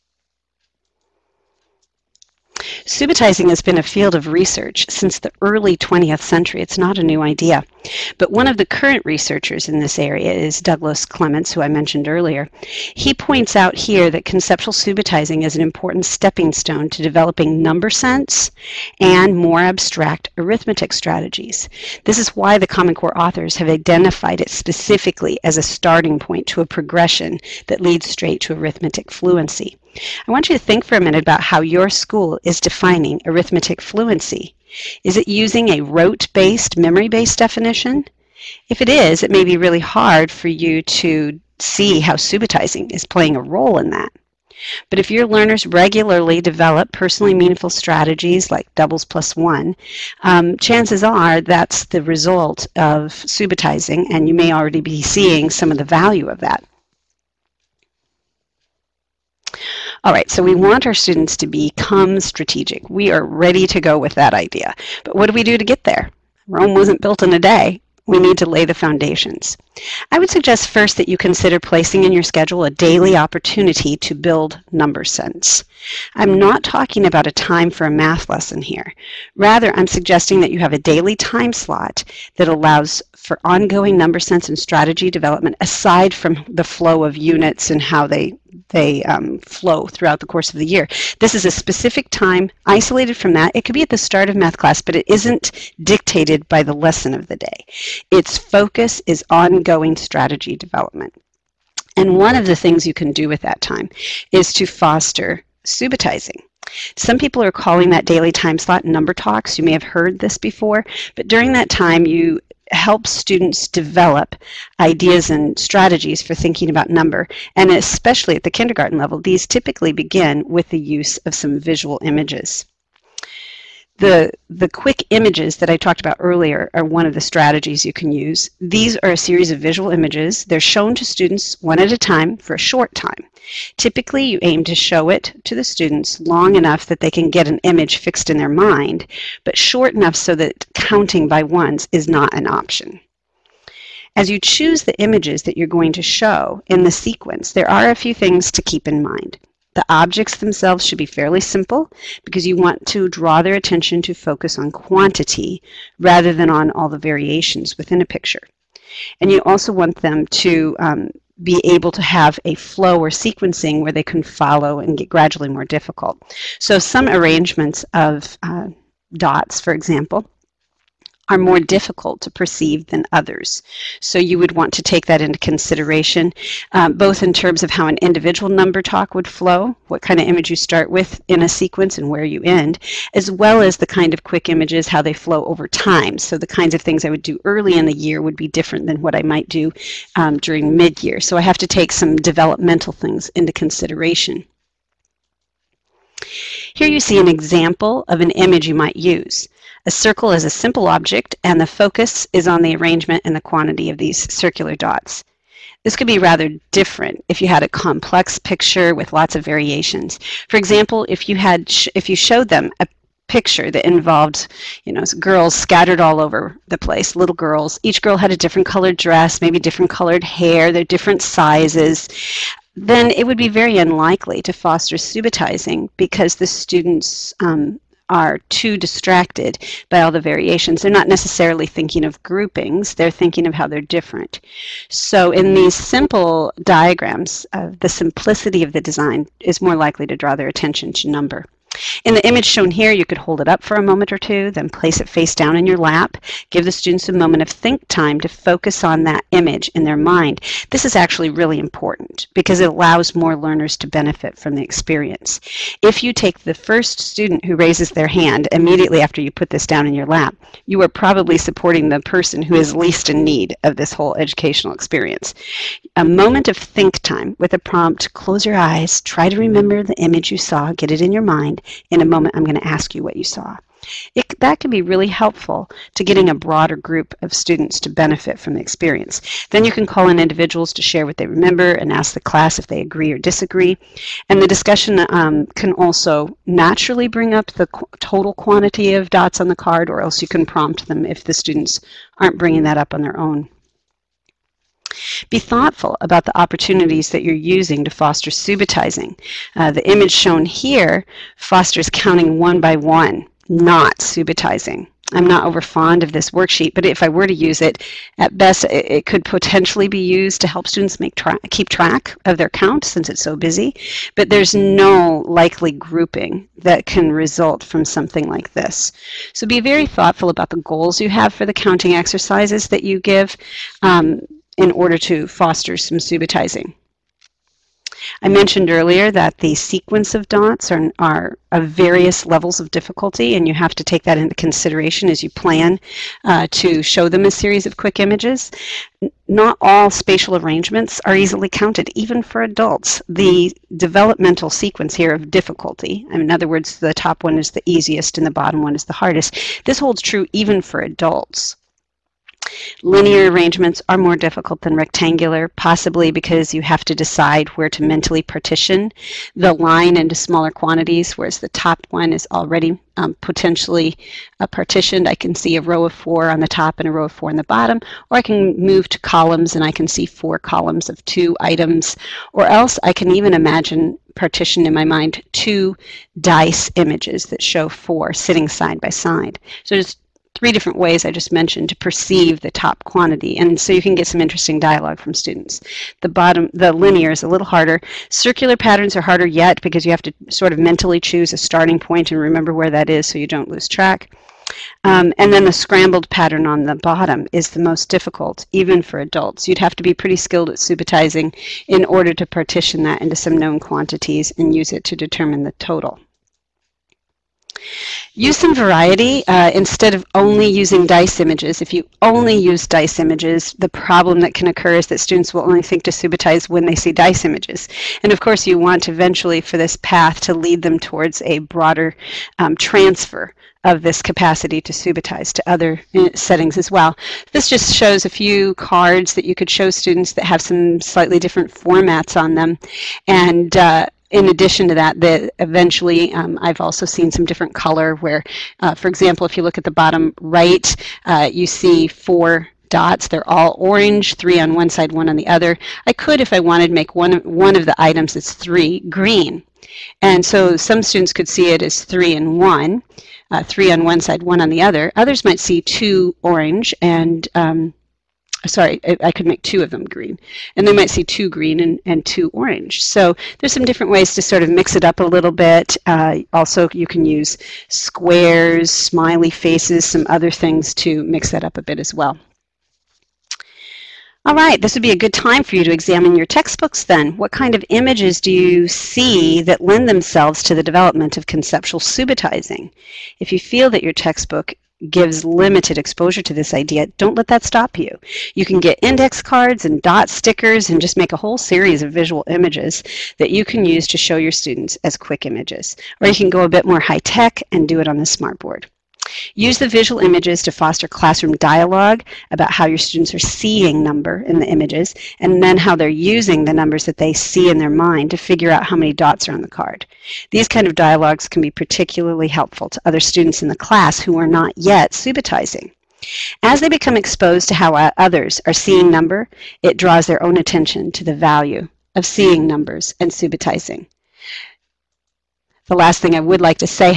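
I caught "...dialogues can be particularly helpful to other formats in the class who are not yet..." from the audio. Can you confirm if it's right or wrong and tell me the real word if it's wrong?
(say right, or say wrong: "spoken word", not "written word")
wrong: "students", not "formats".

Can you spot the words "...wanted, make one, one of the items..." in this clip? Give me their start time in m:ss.
7:26.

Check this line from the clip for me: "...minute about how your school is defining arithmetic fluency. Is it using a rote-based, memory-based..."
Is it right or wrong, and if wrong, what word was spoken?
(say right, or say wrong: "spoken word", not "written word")
right.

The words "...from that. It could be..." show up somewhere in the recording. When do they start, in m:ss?
1:33.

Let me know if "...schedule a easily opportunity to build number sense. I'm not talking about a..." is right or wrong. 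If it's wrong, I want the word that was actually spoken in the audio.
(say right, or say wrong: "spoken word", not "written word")
wrong: "daily", not "easily".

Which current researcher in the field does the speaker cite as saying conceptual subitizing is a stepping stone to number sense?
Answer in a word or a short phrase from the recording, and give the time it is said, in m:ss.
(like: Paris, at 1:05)
Douglas Clements, at 0:10.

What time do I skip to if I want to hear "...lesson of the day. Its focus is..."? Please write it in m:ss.
1:36.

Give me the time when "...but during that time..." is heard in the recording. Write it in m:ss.
1:51.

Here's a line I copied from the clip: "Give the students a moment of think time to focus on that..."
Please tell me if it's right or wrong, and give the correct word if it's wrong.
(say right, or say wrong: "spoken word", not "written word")
right.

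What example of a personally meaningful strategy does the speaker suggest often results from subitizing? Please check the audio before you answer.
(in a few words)
doubles plus one.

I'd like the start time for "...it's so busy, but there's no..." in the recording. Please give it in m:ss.
5:13.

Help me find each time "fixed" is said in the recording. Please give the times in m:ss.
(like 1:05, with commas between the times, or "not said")
2:17.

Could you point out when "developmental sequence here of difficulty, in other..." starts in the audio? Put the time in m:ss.
5:43.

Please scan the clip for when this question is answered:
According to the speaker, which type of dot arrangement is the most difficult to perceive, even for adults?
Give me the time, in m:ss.
6:35.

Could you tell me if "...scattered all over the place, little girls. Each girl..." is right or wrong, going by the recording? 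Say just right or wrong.
right.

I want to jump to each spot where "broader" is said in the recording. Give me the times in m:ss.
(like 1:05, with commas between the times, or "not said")
4:36, 7:01.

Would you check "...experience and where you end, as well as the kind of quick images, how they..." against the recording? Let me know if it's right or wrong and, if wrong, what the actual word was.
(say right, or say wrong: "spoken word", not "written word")
wrong: "sequence", not "experience".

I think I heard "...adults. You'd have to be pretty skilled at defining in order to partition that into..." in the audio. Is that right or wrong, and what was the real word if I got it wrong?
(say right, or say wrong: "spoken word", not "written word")
wrong: "subitizing", not "defining".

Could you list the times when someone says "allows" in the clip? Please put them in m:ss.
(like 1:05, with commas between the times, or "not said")
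1:22, 4:12.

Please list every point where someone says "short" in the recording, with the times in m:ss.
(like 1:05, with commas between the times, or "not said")
2:12, 2:19.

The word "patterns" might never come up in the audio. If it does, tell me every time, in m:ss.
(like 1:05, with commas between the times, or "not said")
6:28, 6:36.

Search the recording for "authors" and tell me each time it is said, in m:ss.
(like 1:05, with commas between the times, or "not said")
0:23.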